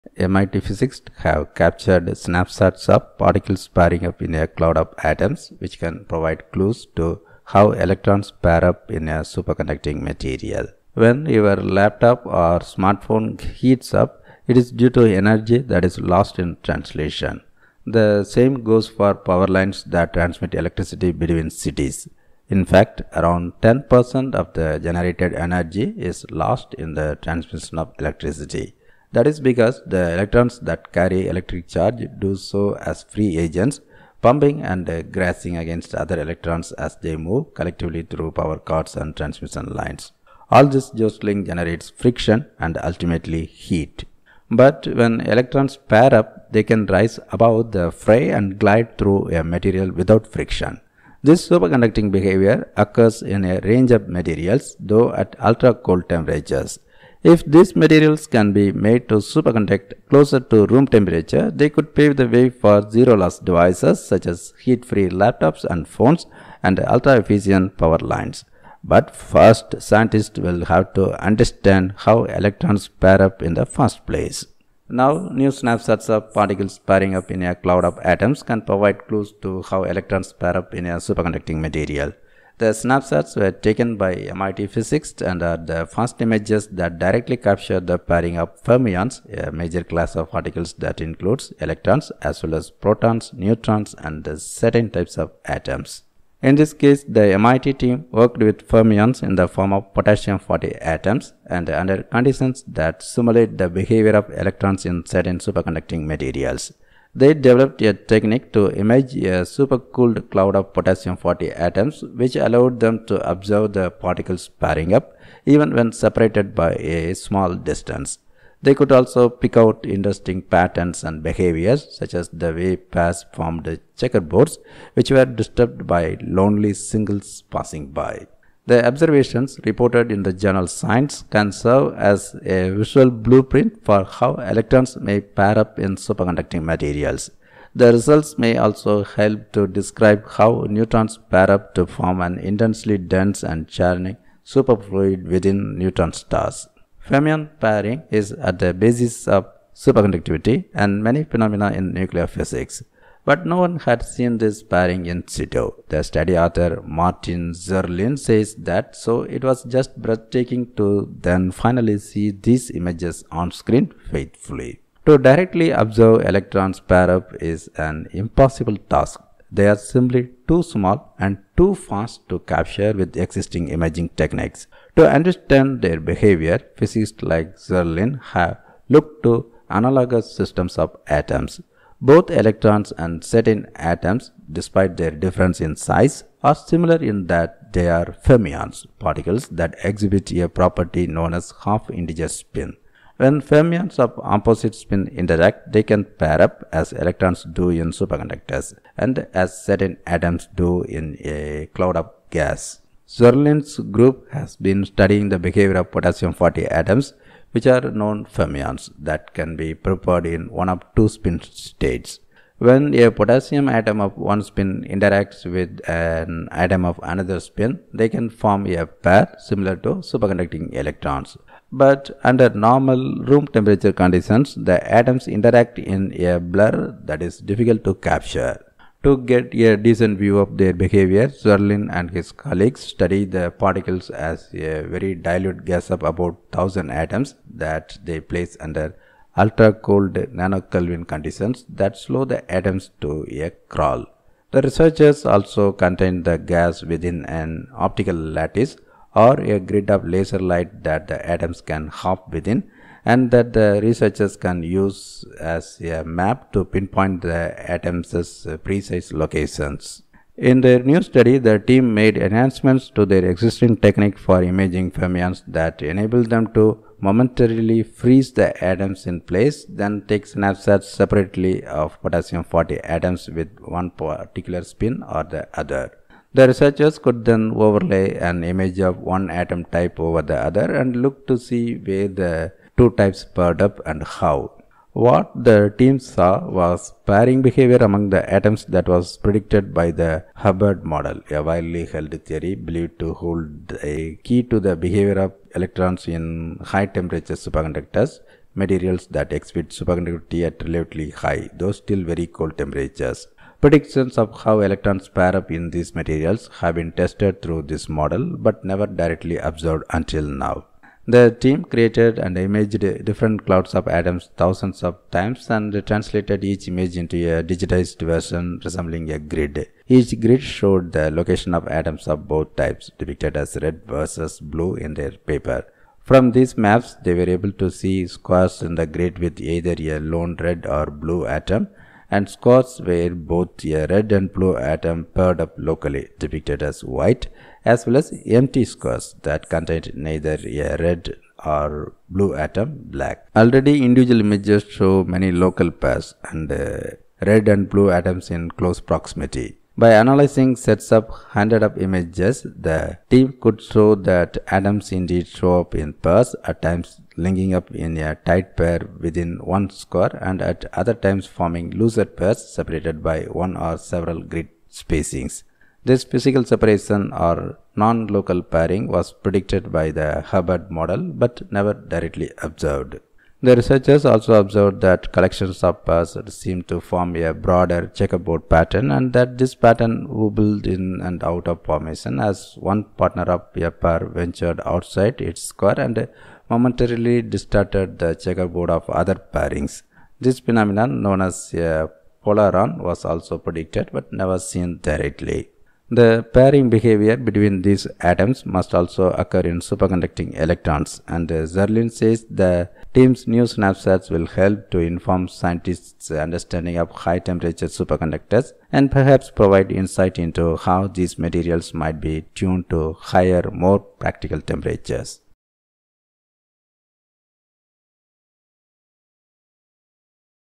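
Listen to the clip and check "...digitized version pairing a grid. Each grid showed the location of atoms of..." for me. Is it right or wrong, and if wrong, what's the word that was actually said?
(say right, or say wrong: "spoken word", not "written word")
wrong: "resembling", not "pairing".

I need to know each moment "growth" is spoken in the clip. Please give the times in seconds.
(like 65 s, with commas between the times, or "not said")
not said.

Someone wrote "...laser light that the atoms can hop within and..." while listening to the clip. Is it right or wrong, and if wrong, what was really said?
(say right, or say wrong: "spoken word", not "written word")
right.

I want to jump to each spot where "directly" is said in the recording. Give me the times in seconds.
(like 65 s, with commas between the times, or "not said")
86 s, 165 s, 308 s, 371 s, 394 s.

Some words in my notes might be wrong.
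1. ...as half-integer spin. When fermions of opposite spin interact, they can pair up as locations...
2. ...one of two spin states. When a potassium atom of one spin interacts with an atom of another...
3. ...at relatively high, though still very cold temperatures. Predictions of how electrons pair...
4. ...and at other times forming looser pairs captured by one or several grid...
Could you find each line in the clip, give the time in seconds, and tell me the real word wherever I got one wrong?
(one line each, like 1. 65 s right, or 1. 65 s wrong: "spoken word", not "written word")
1. 191 s wrong: "electrons", not "locations"
2. 210 s right
3. 300 s right
4. 360 s wrong: "separated", not "captured".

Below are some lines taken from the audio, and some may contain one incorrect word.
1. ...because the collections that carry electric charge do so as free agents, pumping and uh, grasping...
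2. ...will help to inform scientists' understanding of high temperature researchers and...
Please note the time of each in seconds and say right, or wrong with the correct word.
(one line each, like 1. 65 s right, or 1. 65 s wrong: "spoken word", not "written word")
1. 29 s wrong: "electrons", not "collections"
2. 404 s wrong: "superconductors", not "researchers".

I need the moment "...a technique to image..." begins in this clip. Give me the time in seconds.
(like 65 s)
107 s.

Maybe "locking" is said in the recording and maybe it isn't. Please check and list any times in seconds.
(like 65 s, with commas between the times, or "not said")
not said.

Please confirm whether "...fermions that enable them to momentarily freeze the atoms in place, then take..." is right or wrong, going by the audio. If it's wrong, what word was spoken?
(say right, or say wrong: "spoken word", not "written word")
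right.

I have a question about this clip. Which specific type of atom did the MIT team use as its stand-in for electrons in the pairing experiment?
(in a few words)
potassium-40.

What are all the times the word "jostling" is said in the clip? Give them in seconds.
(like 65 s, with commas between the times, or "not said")
40 s.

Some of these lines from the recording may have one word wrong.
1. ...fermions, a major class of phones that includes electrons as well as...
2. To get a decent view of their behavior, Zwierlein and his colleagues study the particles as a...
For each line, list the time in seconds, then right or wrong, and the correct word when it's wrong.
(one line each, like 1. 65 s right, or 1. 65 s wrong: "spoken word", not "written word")
1. 88 s wrong: "particles", not "phones"
2. 229 s right.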